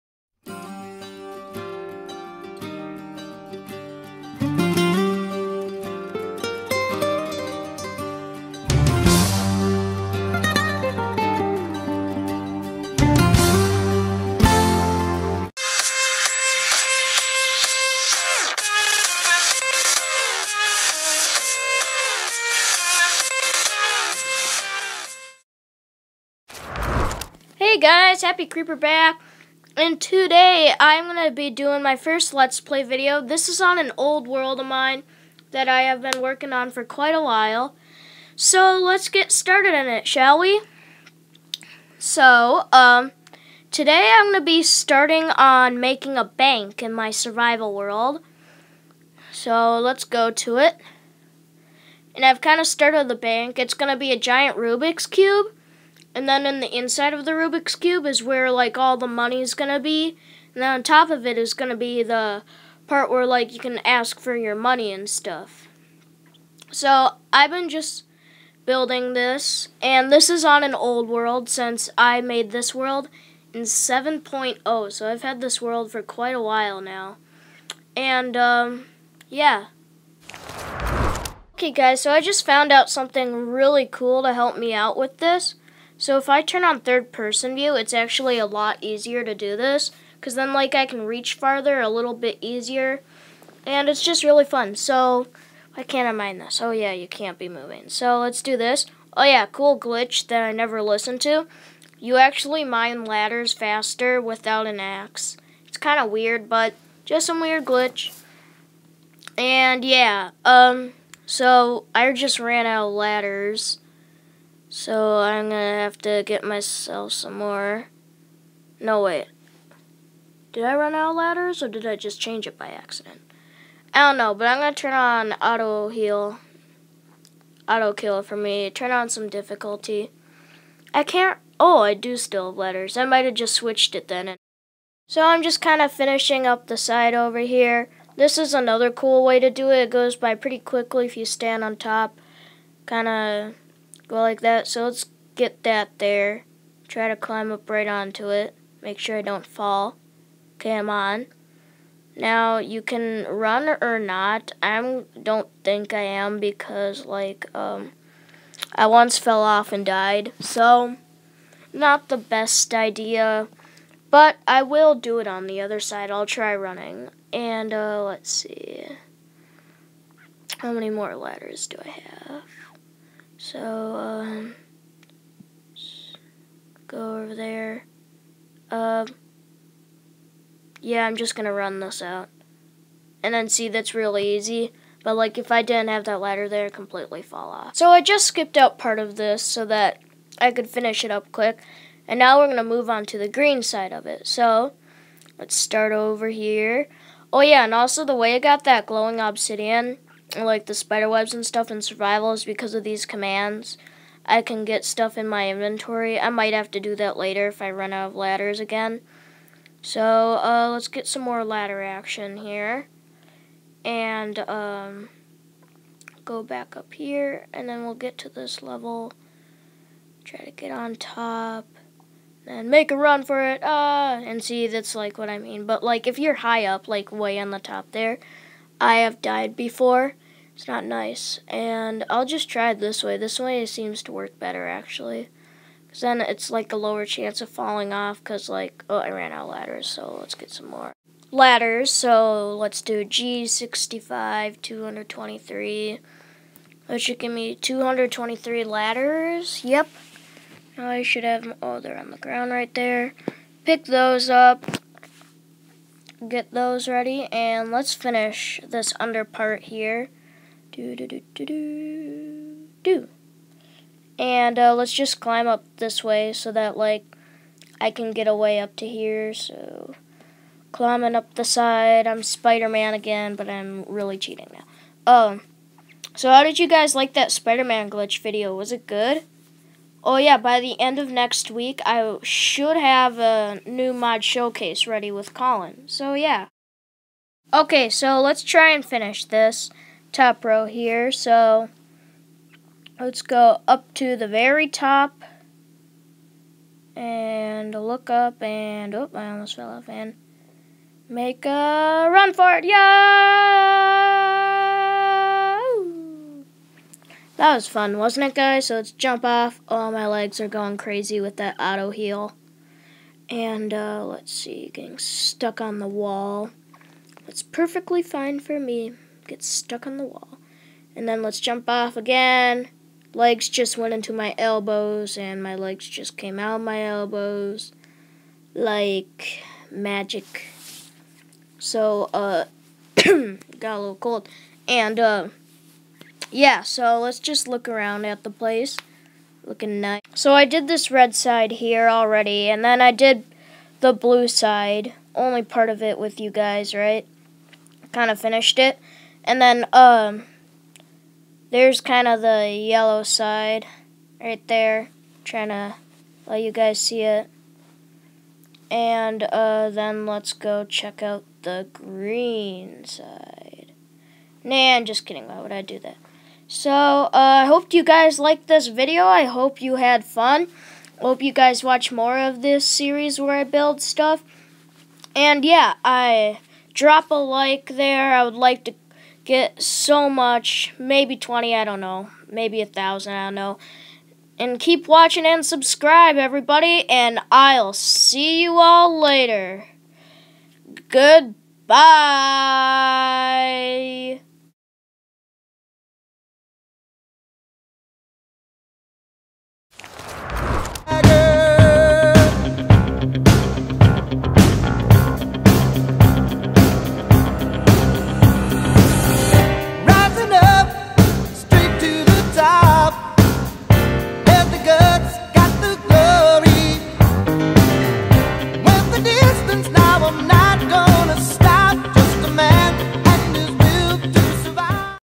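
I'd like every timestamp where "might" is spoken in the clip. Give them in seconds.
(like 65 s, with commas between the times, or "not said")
133 s, 206 s.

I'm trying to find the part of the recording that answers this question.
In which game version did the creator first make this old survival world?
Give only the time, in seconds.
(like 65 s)
73 s.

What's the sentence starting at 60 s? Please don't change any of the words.
And then on top of it is gonna be the part where like you can ask for your money and stuff.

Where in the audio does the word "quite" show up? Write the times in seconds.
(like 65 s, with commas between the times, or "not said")
36 s, 76 s.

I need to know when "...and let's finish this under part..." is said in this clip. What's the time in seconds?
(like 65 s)
257 s.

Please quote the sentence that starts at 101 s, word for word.
You actually mine ladders faster without an axe.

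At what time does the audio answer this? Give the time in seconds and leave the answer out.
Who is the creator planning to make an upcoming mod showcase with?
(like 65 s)
285 s.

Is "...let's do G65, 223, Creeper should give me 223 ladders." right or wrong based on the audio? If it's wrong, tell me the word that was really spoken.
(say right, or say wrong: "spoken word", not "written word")
wrong: "That", not "Creeper".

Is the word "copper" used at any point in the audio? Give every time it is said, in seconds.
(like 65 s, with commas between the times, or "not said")
not said.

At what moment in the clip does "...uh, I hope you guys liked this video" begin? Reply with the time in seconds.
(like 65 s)
366 s.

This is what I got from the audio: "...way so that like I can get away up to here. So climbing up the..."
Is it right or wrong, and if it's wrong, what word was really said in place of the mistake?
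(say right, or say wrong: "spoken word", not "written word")
right.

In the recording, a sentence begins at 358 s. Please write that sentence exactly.
And uh, then let's go check out the green side.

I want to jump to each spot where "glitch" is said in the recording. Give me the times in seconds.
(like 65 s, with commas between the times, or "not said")
99 s, 107 s, 277 s.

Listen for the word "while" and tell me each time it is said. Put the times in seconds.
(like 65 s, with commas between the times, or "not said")
37 s, 76 s.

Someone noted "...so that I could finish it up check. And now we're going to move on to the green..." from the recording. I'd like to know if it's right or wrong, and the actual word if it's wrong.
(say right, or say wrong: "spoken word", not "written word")
wrong: "quick", not "check".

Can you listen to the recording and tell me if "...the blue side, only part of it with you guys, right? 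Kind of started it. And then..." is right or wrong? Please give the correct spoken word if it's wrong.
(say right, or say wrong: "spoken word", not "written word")
wrong: "finished", not "started".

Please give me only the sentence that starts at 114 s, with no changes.
So I'm gonna have to get myself some more.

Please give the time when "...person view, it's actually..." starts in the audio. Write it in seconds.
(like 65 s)
87 s.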